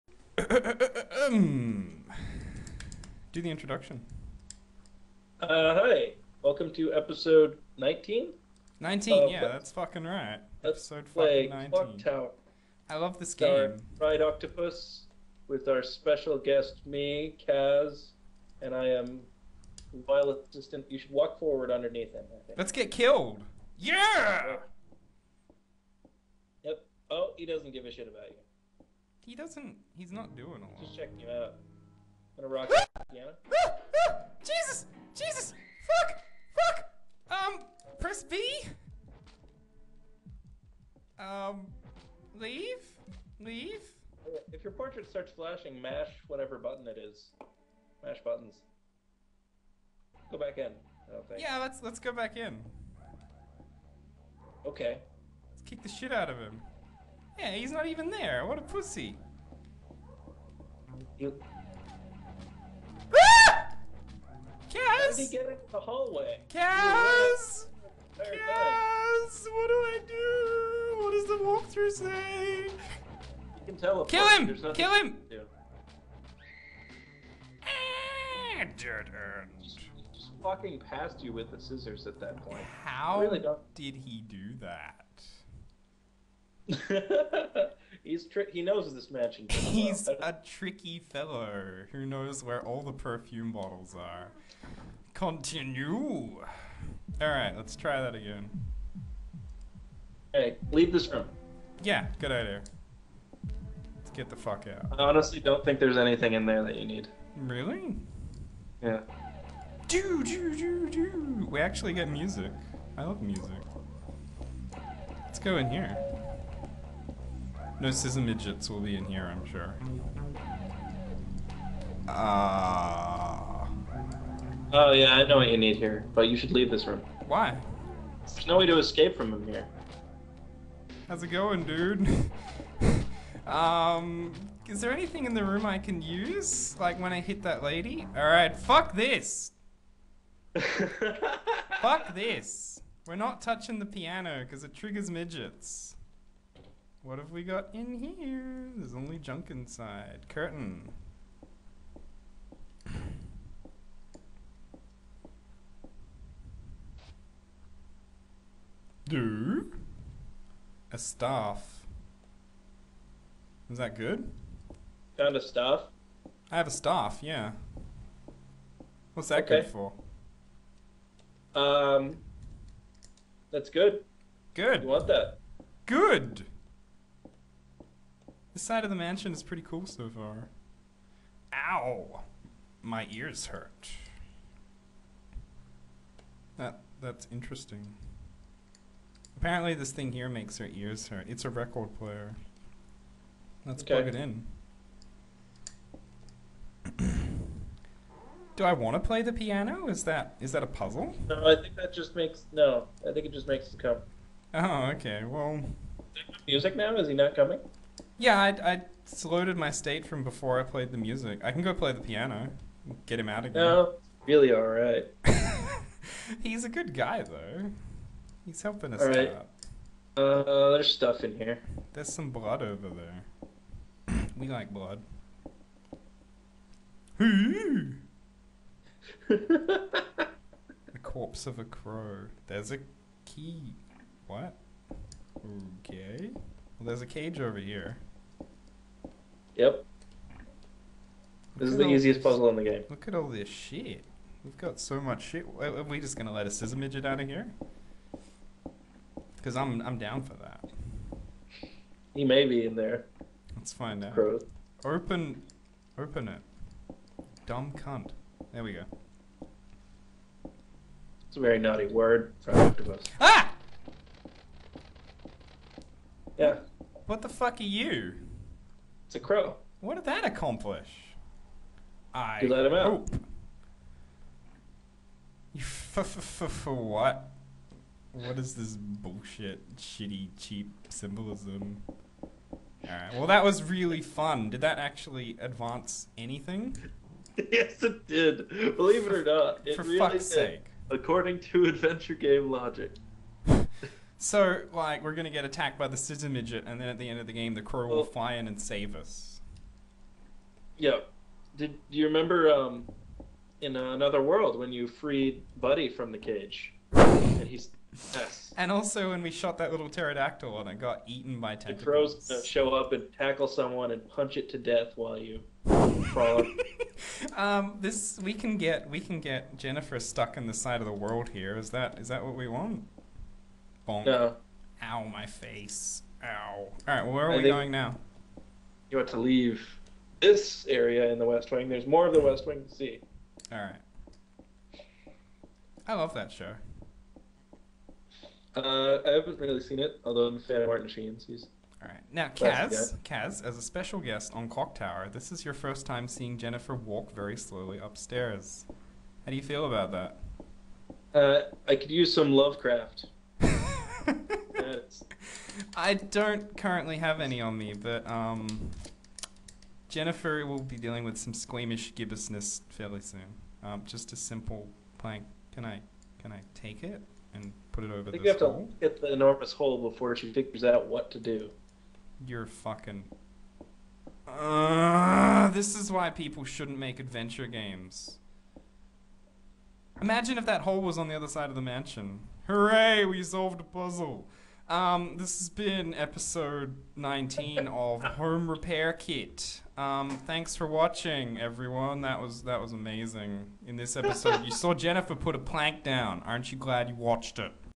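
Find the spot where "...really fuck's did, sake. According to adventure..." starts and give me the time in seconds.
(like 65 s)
289 s.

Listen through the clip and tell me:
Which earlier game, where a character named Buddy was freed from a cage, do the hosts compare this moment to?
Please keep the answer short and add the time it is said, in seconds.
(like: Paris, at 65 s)
Another World, at 303 s.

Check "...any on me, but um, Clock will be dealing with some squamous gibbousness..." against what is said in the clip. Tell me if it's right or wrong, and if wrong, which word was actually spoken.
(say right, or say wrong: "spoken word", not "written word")
wrong: "Jennifer", not "Clock".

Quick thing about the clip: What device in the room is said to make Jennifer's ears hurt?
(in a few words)
Record player.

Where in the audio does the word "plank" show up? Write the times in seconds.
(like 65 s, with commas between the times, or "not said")
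364 s, 395 s.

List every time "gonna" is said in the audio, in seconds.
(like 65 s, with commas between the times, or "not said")
32 s, 246 s.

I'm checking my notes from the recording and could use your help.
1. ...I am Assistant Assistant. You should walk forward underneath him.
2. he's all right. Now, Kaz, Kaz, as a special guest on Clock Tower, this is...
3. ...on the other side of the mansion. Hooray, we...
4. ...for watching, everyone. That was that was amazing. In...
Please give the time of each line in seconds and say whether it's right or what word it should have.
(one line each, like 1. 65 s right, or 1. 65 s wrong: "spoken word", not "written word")
1. 18 s wrong: "Violet", not "Assistant"
2. 341 s right
3. 380 s right
4. 390 s right.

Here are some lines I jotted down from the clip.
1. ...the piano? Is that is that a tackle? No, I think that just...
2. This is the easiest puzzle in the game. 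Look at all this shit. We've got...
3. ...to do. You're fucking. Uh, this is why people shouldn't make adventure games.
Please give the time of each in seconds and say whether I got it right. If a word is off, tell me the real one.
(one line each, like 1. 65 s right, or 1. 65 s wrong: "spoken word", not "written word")
1. 199 s wrong: "puzzle", not "tackle"
2. 241 s right
3. 371 s right.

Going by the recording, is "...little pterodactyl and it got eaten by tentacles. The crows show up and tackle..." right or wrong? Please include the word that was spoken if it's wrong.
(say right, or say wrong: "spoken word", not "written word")
right.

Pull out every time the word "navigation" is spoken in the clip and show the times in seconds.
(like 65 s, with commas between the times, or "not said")
not said.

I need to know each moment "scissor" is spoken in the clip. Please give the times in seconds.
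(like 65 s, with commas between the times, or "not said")
81 s, 117 s, 246 s, 295 s.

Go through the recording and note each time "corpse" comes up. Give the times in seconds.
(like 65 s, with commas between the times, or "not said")
231 s.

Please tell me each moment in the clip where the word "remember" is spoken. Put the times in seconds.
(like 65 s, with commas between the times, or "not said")
302 s.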